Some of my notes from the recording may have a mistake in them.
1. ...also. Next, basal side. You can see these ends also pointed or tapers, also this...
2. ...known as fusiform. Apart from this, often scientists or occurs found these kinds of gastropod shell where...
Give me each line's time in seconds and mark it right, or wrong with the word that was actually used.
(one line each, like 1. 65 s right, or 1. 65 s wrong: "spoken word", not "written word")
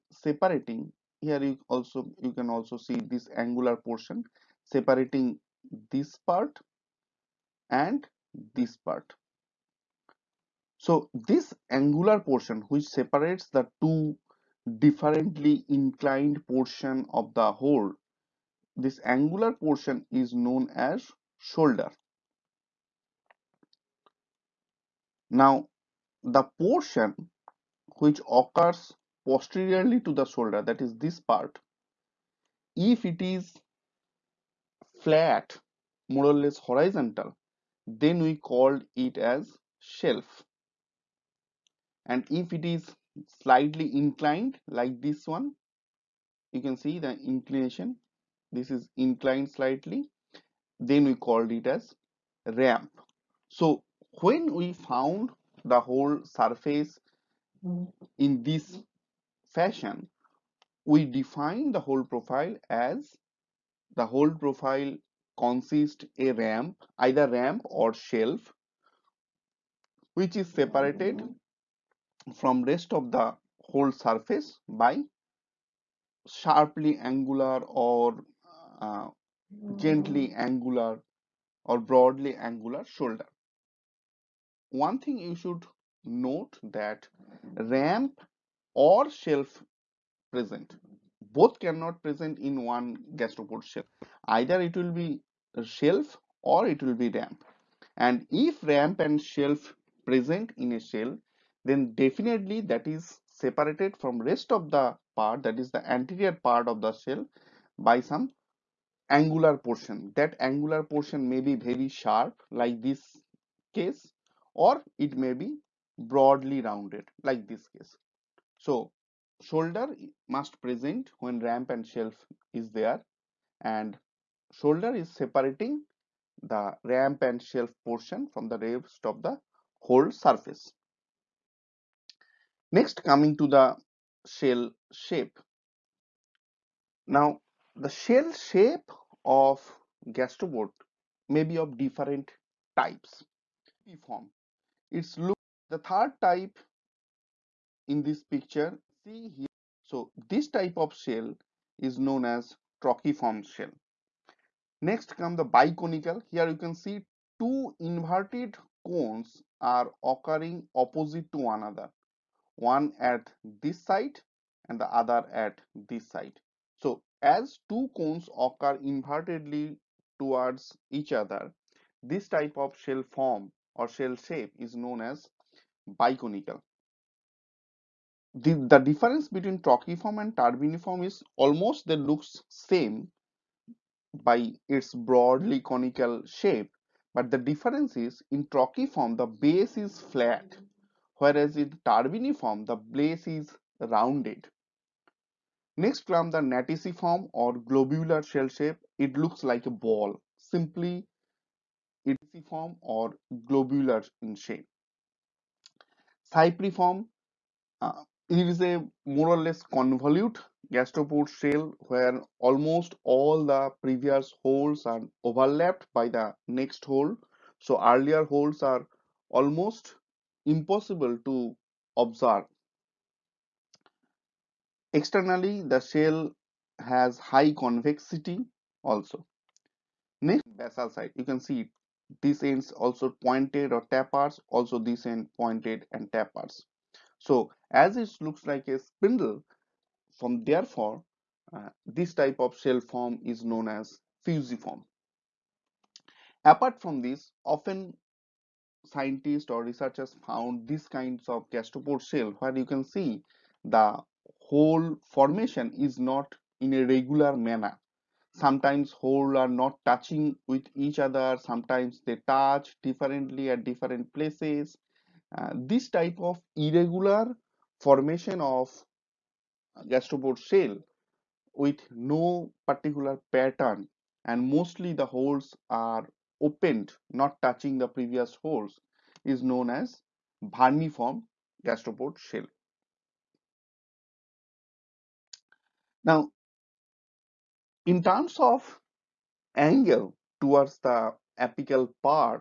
1. 228 s right
2. 243 s wrong: "researchers", not "occurs".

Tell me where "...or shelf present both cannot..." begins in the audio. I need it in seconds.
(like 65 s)
88 s.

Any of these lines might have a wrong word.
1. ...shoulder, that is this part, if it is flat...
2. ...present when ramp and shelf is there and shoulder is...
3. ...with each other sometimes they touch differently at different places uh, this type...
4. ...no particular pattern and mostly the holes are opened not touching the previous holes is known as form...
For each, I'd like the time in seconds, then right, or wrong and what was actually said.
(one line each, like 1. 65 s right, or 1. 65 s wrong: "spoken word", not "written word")
1. 30 s right
2. 120 s right
3. 260 s right
4. 272 s right.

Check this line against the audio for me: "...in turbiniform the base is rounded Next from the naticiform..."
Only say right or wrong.
right.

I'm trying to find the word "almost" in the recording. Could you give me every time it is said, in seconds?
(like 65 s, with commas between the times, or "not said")
181 s, 212 s, 219 s.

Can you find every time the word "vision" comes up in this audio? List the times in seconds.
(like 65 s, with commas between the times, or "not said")
not said.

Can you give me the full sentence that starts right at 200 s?
Simply form or globular in shape.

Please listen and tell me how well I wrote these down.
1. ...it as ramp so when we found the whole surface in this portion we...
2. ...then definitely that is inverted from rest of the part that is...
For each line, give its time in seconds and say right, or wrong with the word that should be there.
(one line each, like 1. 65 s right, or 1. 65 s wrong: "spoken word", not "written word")
1. 51 s wrong: "fashion", not "portion"
2. 101 s wrong: "separated", not "inverted".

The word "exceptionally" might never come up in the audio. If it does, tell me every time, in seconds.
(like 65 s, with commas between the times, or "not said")
not said.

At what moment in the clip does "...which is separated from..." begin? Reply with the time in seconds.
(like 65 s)
70 s.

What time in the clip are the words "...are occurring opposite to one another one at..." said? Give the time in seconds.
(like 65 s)
159 s.